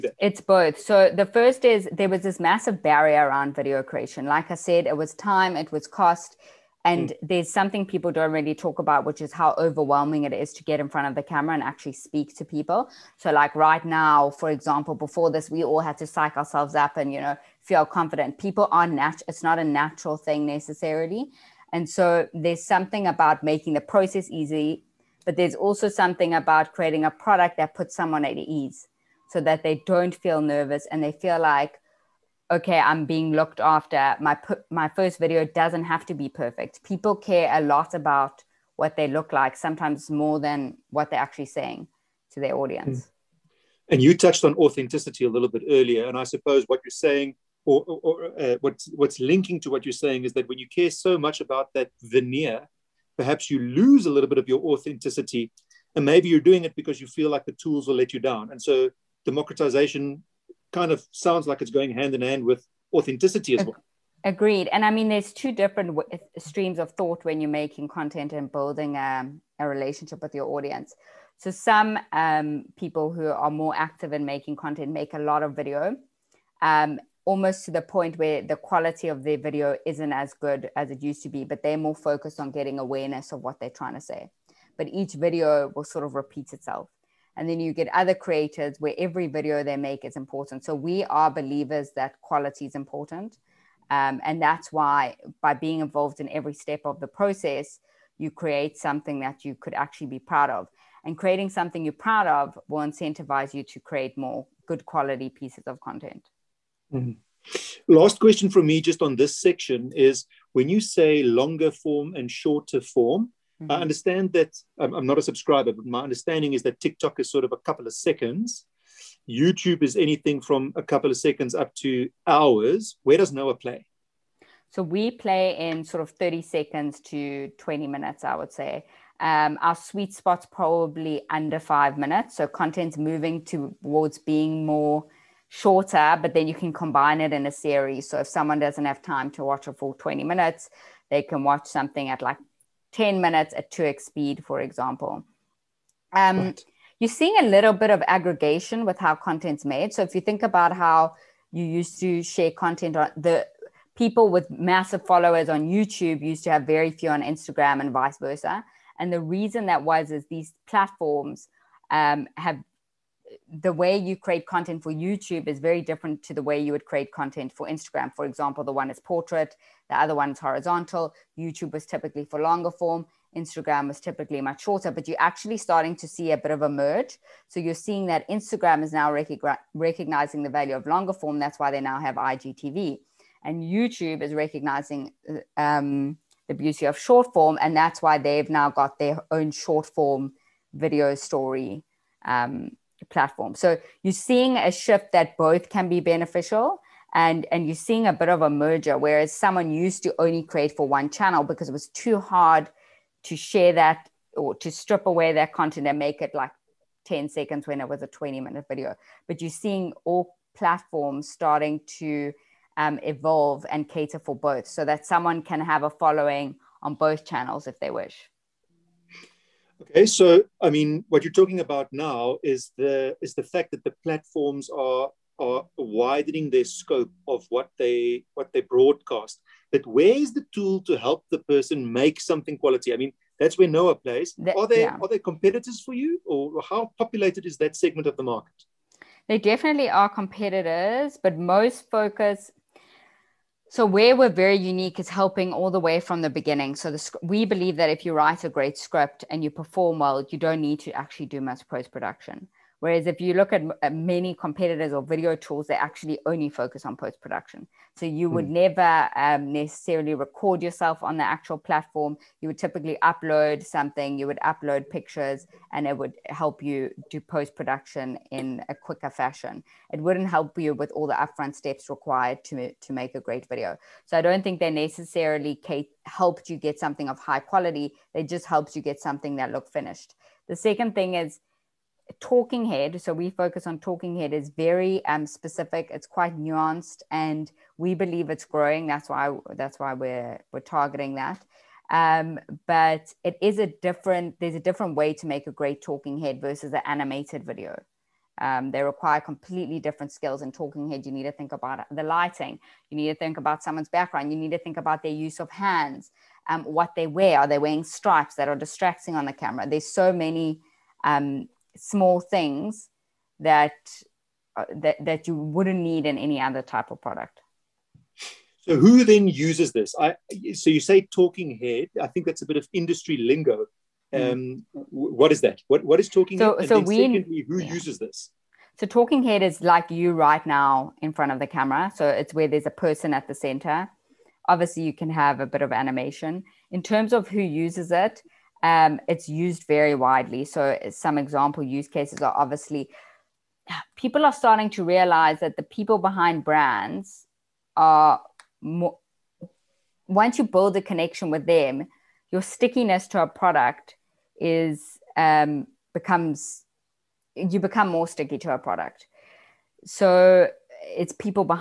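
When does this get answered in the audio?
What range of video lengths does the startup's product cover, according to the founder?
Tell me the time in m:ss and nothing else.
2:06.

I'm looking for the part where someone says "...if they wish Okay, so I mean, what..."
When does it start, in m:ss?
3:37.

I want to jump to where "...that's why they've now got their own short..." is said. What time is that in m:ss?
3:07.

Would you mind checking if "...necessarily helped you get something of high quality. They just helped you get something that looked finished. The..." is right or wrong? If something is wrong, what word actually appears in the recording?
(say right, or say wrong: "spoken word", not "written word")
right.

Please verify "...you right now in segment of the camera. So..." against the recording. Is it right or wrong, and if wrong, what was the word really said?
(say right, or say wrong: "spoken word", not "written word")
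wrong: "front", not "segment".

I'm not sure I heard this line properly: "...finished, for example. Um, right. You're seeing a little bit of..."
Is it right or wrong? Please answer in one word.
wrong.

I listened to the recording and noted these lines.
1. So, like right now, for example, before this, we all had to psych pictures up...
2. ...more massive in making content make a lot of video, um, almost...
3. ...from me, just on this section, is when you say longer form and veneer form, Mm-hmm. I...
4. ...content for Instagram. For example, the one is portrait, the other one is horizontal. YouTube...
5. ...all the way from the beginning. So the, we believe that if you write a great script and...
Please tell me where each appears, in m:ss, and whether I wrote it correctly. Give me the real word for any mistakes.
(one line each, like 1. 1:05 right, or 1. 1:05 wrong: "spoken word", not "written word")
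1. 0:13 wrong: "ourselves", not "pictures"
2. 1:13 wrong: "active", not "massive"
3. 1:48 wrong: "shorter", not "veneer"
4. 2:47 right
5. 4:05 right.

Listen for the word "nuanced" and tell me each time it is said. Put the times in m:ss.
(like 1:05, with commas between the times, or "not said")
4:46.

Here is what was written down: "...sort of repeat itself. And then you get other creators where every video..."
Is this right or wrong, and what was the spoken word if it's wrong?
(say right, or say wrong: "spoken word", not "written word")
right.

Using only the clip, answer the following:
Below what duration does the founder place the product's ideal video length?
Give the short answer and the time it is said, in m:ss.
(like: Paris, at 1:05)
under 5 minutes, at 2:11.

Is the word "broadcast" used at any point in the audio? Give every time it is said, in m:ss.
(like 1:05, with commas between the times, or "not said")
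3:48.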